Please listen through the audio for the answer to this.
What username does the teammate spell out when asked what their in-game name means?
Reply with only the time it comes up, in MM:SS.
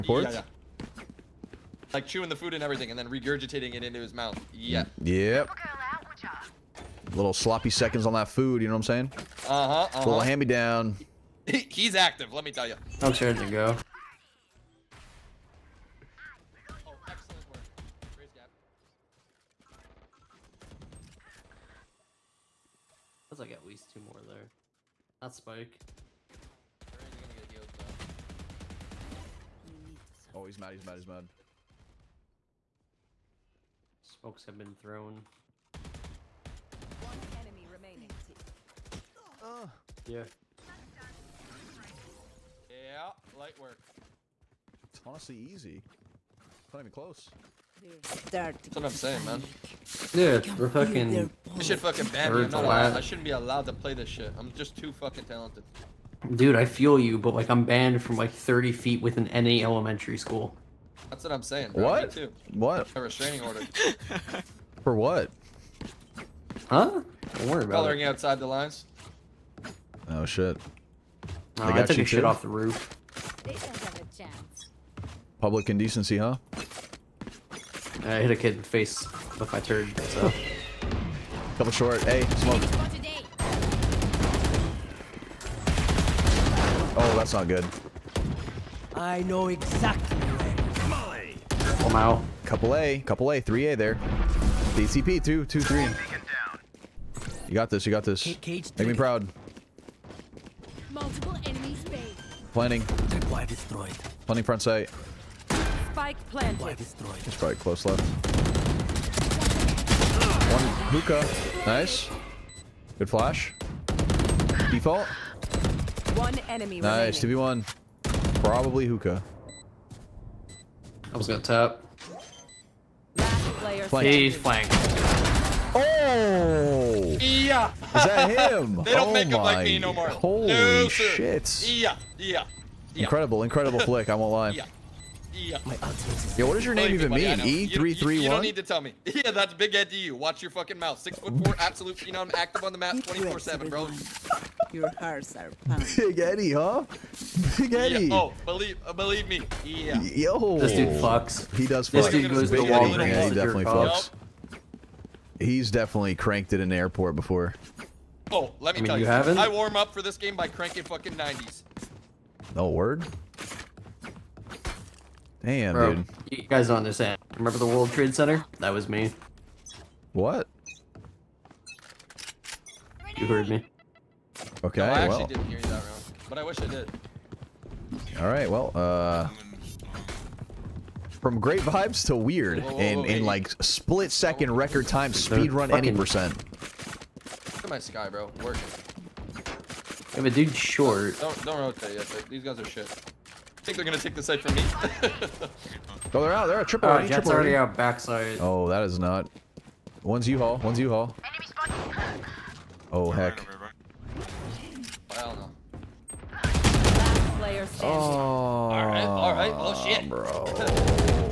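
02:17.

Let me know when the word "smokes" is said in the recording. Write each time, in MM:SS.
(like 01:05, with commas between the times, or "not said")
00:34, 01:22.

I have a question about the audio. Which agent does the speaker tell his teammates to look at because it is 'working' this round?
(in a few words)
Skye.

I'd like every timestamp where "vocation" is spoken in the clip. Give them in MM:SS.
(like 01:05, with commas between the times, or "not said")
not said.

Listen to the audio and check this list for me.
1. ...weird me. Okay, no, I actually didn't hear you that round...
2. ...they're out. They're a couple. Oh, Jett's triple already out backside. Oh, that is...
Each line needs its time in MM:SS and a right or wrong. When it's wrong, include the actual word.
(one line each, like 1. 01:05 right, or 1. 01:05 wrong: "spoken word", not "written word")
1. 02:53 wrong: "heard", not "weird"
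2. 03:16 wrong: "triple", not "couple".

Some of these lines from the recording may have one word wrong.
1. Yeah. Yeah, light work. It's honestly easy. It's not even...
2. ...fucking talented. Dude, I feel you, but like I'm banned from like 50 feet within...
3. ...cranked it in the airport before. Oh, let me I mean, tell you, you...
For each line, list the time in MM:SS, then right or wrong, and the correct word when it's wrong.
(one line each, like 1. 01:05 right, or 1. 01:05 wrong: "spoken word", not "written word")
1. 00:40 right
2. 00:54 wrong: "30", not "50"
3. 02:36 right.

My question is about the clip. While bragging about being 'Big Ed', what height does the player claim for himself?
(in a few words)
6 foot 4.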